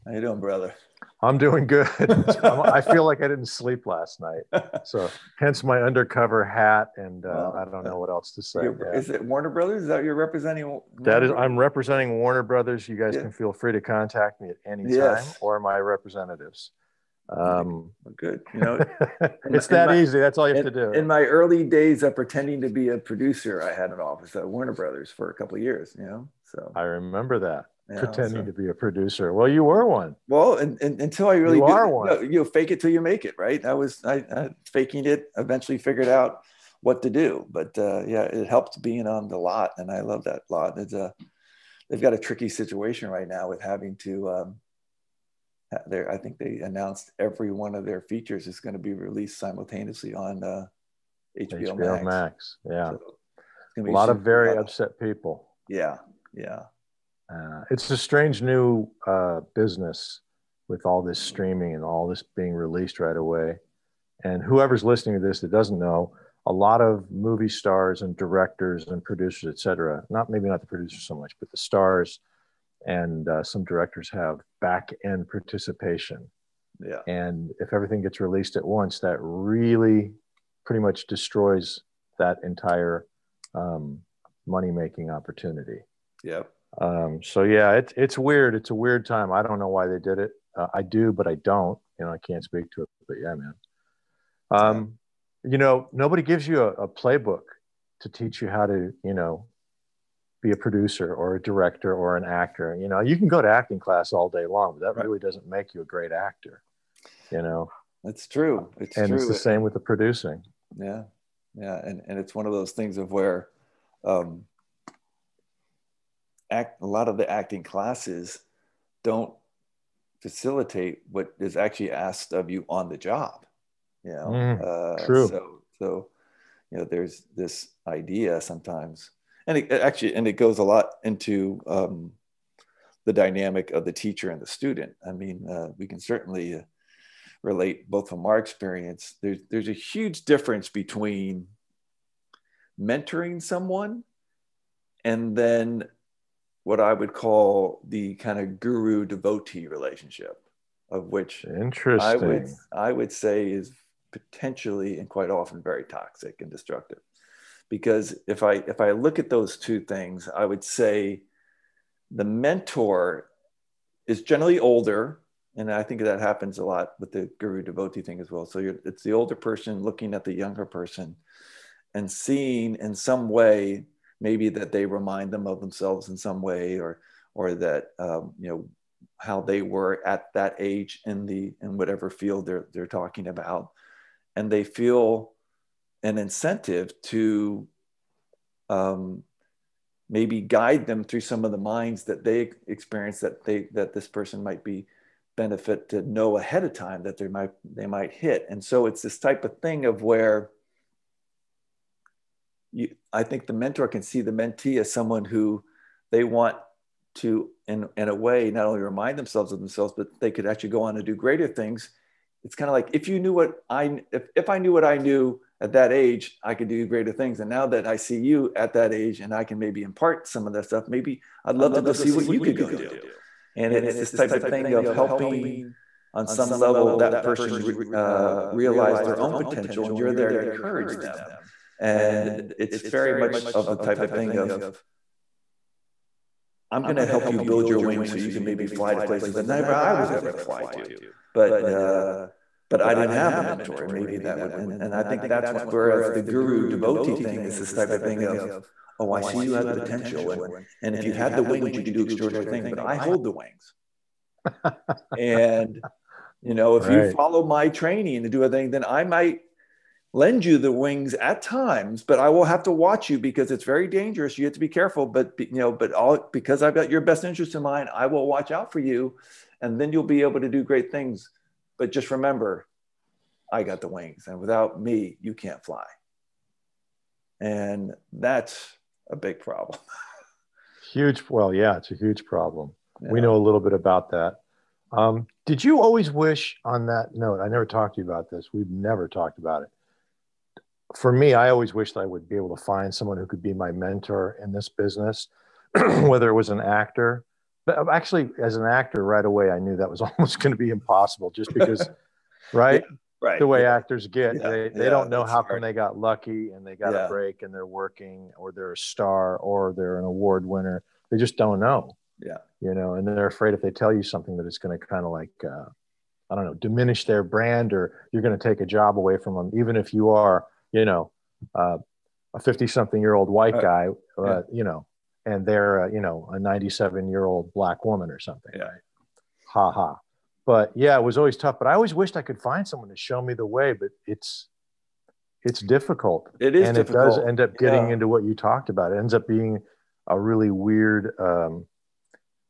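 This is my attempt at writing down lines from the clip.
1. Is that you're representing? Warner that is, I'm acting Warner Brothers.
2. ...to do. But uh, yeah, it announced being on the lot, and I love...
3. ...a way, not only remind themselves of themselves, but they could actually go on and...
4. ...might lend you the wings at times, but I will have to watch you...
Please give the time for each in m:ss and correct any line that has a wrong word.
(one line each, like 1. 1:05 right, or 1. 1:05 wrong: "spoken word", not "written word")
1. 0:09 wrong: "representing", not "acting"
2. 0:37 wrong: "helped", not "announced"
3. 3:28 right
4. 4:19 right.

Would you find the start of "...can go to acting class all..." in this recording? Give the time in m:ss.
1:43.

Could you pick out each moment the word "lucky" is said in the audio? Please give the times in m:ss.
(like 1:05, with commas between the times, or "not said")
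5:05.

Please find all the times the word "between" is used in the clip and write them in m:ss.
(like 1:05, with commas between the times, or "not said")
2:20.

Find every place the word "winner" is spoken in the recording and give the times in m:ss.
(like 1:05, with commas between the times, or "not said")
5:10.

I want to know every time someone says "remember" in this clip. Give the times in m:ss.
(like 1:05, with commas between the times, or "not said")
0:26, 4:32.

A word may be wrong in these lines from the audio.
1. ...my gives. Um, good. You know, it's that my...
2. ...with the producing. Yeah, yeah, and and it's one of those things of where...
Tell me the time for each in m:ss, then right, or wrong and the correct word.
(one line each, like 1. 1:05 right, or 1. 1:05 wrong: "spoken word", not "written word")
1. 0:15 wrong: "representatives", not "gives"
2. 1:49 right.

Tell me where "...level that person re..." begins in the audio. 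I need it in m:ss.
3:46.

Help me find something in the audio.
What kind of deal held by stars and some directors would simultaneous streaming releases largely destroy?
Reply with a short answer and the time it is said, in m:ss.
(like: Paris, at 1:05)
back end participation, at 1:14.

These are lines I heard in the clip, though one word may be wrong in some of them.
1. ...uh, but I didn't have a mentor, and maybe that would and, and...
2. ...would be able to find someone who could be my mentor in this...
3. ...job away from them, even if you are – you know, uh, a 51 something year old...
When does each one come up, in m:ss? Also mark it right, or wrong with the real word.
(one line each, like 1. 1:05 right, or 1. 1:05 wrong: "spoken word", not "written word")
1. 4:01 right
2. 4:52 right
3. 5:18 wrong: "50", not "51".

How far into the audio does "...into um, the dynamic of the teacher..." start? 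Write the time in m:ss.
2:11.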